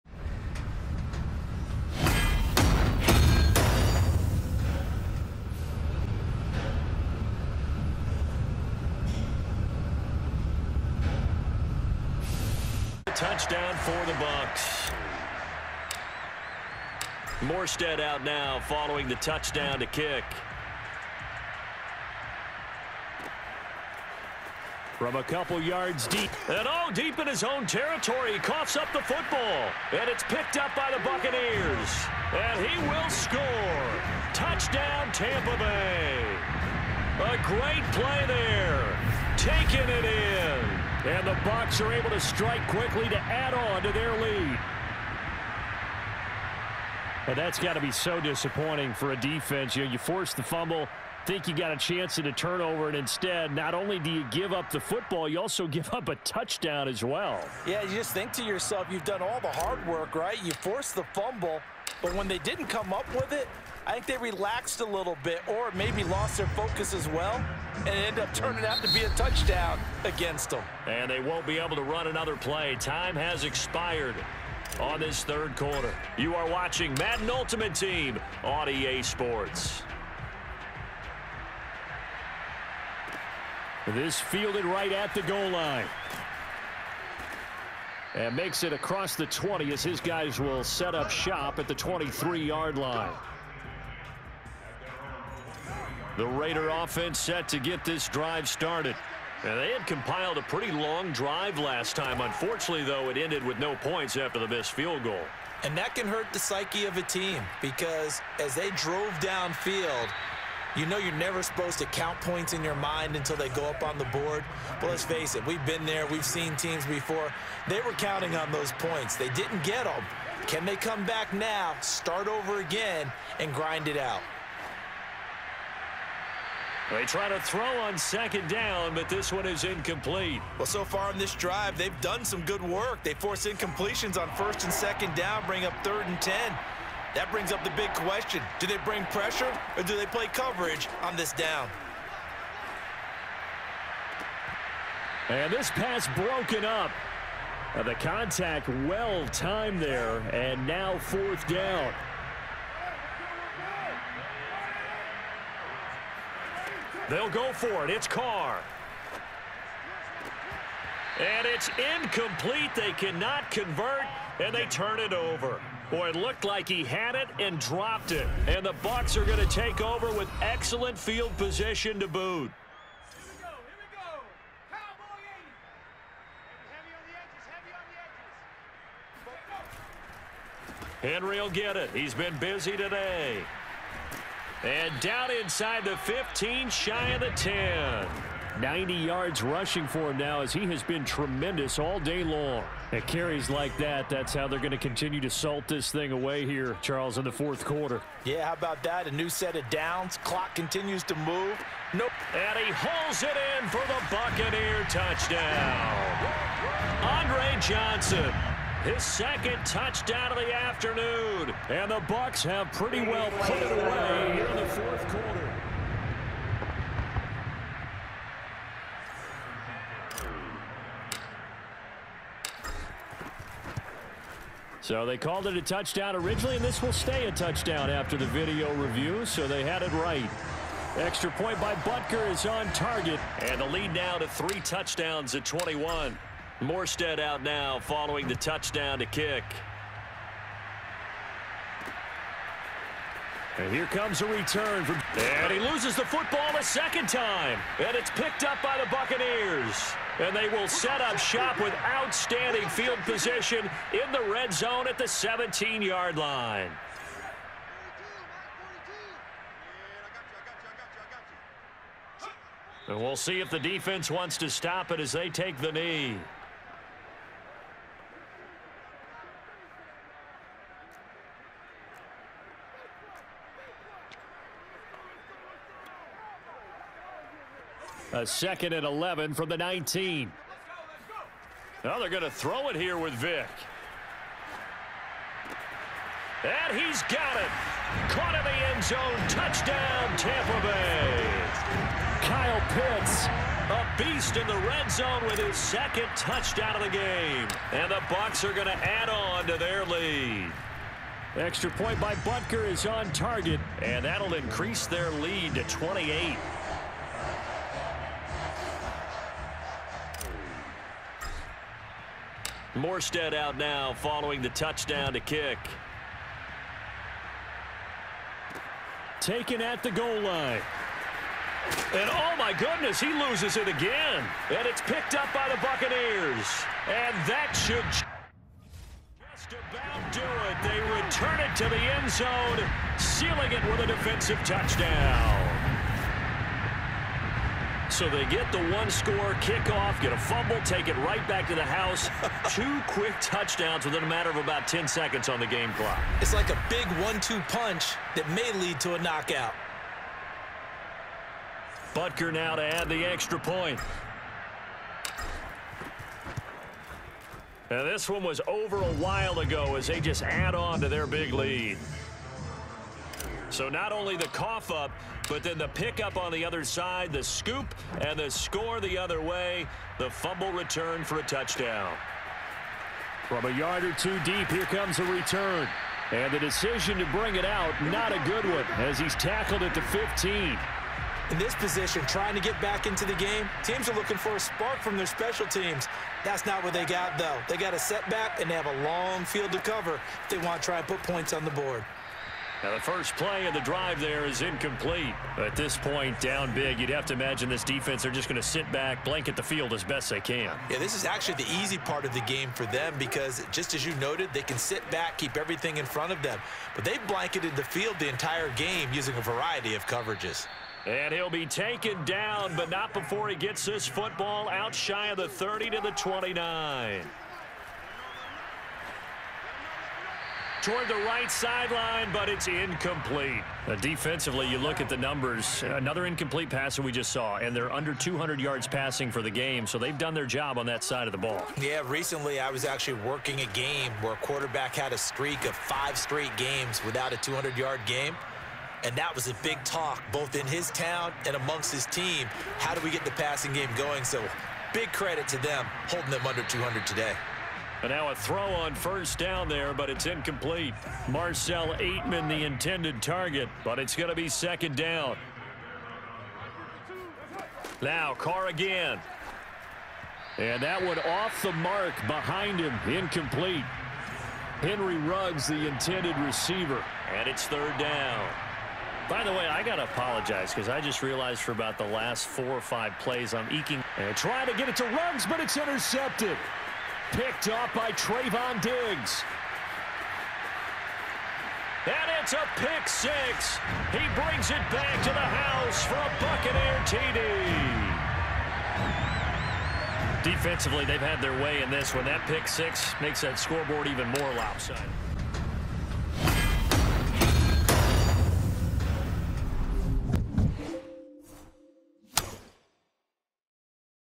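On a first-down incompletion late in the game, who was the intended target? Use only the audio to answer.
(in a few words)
Marcell Ateman.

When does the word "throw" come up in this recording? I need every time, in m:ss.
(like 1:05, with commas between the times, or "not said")
2:07, 4:42, 7:28.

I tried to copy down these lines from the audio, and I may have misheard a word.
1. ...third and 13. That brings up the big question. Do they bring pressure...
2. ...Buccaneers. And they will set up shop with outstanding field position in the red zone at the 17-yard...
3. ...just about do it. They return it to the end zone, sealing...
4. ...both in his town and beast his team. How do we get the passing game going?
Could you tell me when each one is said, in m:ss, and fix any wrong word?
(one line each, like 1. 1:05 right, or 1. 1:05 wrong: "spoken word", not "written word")
1. 2:15 wrong: "10", not "13"
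2. 4:08 right
3. 5:27 right
4. 7:20 wrong: "amongst", not "beast".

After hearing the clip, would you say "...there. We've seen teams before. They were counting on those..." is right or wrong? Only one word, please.
right.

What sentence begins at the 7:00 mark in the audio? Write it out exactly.
toward the right sideline, but it's incomplete.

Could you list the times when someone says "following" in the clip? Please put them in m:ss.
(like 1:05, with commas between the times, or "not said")
0:18, 3:57, 5:13.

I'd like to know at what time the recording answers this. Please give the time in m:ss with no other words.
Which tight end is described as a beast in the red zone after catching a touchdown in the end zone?
4:52.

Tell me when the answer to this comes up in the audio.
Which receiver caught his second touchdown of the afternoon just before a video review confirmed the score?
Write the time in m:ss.
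3:27.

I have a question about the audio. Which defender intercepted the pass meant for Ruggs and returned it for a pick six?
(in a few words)
Trevon Diggs.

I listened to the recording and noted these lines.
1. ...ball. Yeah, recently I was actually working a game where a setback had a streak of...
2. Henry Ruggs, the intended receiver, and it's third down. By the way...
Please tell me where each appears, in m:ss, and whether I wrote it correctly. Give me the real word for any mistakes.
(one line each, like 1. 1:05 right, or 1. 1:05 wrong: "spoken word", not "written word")
1. 7:11 wrong: "quarterback", not "setback"
2. 7:44 right.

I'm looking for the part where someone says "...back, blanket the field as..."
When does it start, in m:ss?
6:38.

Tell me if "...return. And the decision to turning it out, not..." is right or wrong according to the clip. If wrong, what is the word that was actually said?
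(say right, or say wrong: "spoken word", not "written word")
wrong: "bring", not "turning".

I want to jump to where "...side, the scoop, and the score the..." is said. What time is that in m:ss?
6:06.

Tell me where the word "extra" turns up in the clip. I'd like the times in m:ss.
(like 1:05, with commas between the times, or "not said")
3:50, 5:01, 5:53.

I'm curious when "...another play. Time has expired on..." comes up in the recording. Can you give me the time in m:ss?
1:12.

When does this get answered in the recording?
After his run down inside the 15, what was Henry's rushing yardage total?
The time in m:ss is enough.
3:08.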